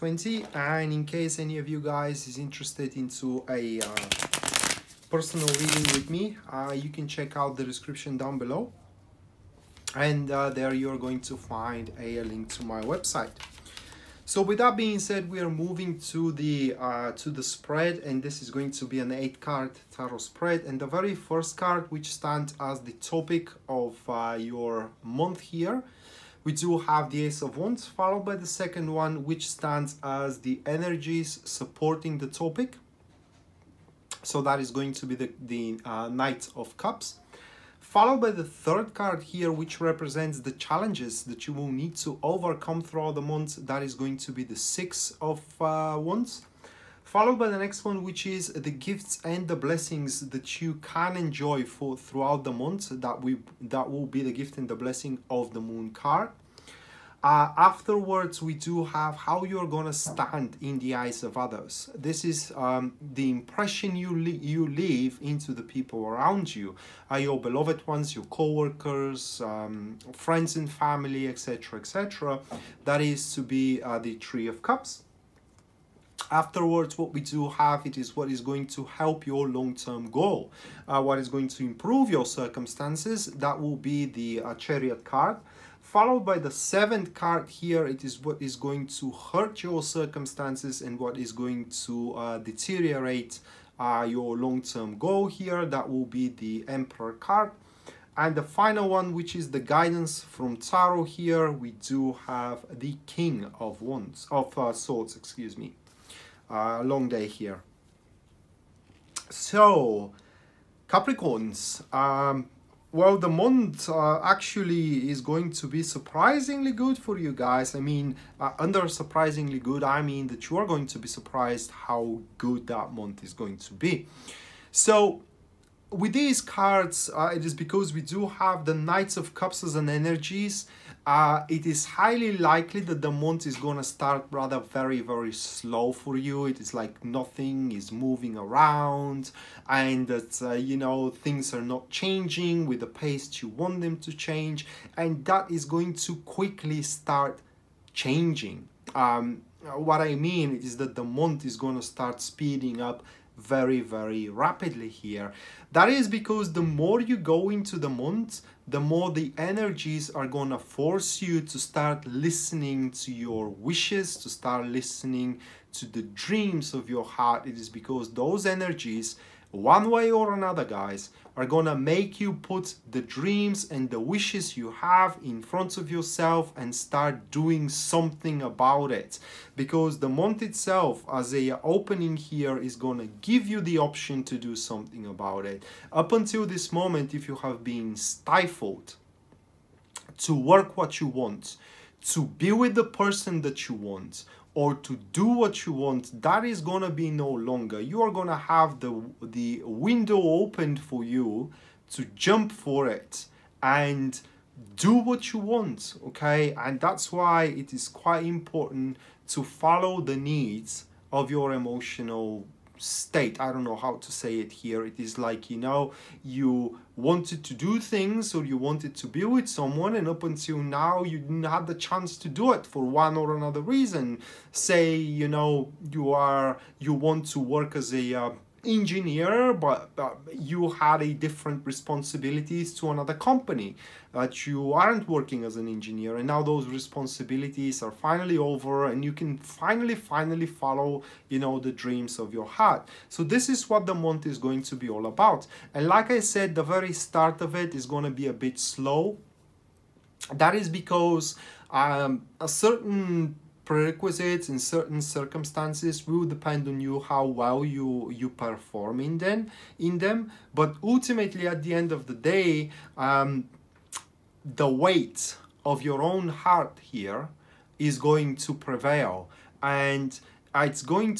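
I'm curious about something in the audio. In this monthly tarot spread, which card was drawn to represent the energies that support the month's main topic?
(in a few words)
Knight of Cups.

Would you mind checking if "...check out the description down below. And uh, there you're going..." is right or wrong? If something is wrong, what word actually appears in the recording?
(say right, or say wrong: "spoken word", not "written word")
right.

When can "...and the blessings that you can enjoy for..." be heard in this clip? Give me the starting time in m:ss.
0:49.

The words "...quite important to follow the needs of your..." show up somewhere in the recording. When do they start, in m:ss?
3:27.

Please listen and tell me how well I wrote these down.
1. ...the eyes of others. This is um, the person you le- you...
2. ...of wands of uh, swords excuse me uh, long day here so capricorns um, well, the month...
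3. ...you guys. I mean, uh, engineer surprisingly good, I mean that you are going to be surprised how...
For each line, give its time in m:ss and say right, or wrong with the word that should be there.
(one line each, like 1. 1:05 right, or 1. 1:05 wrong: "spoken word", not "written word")
1. 1:00 wrong: "impression", not "person"
2. 1:43 right
3. 1:57 wrong: "under", not "engineer".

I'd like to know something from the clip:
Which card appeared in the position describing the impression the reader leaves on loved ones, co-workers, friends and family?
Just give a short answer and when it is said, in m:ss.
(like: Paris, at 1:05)
Three of Cups, at 1:14.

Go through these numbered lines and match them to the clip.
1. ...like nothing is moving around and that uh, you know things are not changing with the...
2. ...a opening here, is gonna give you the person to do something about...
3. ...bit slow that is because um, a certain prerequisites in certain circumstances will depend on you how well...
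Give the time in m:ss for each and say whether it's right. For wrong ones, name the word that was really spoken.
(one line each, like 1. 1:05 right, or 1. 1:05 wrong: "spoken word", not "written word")
1. 2:16 right
2. 3:01 wrong: "option", not "person"
3. 4:08 right.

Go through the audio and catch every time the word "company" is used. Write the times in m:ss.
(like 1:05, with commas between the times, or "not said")
3:53.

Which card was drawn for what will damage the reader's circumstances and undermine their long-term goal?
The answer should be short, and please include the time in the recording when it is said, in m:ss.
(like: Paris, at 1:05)
The Emperor, at 1:36.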